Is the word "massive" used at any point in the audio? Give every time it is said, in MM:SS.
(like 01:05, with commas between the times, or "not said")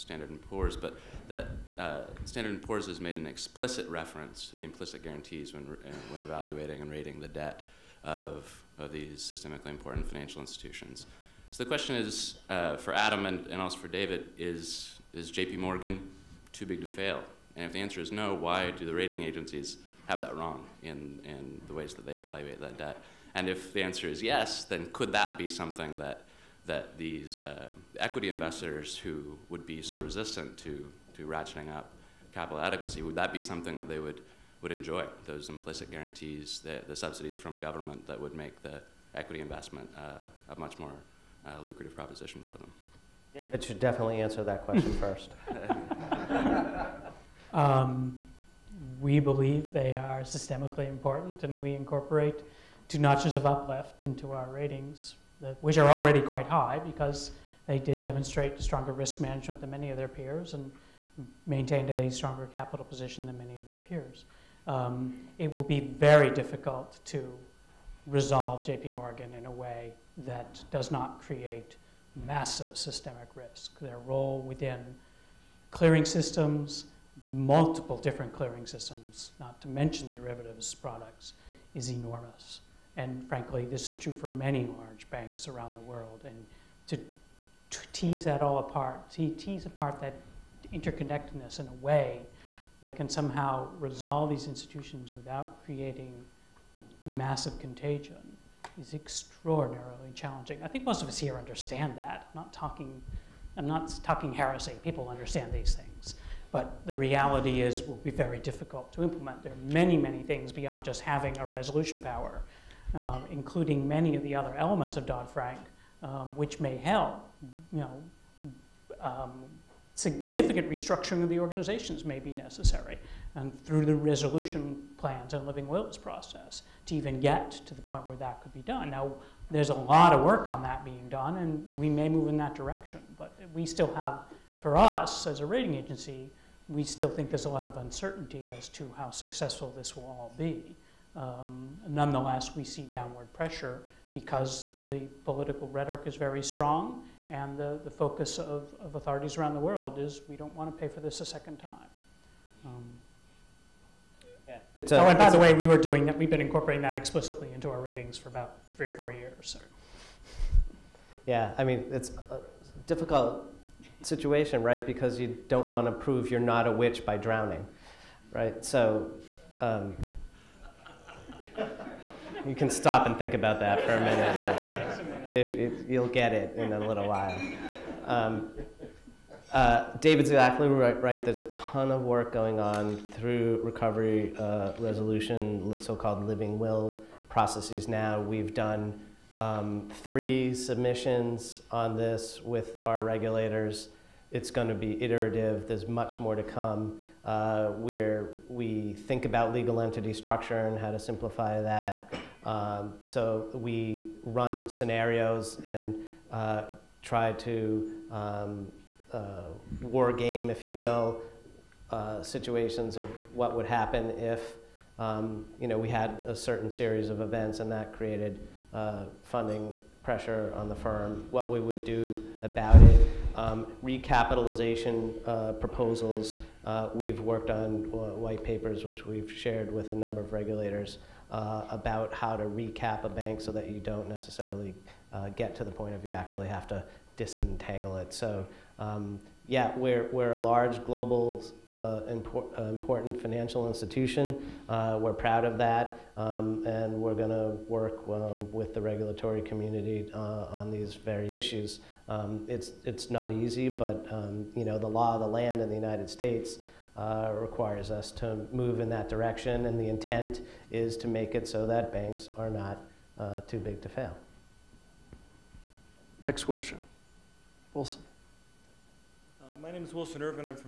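01:12, 01:37.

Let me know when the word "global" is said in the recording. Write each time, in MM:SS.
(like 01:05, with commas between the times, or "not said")
04:00.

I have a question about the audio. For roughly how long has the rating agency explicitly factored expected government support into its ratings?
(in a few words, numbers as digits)
3 or 4 years.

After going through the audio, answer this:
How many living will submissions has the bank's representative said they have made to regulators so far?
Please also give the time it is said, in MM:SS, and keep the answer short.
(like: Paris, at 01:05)
3, at 03:10.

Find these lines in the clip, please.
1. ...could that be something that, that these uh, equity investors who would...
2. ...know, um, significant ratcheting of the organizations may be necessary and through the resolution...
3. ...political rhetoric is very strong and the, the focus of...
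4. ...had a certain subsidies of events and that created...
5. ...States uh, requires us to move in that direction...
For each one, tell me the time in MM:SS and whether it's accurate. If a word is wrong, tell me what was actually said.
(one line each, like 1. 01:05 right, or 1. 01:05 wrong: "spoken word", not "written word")
1. 00:24 right
2. 01:57 wrong: "restructuring", not "ratcheting"
3. 02:25 right
4. 03:35 wrong: "series", not "subsidies"
5. 04:16 right.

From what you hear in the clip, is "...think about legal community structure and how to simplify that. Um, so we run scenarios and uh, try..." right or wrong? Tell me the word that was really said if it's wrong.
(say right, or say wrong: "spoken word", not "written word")
wrong: "entity", not "community".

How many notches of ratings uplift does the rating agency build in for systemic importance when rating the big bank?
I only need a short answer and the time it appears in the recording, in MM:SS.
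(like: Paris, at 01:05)
2, at 00:52.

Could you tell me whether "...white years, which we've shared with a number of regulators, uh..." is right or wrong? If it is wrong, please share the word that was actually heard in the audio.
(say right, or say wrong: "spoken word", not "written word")
wrong: "papers", not "years".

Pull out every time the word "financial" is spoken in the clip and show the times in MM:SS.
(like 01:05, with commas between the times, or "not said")
00:10, 04:03.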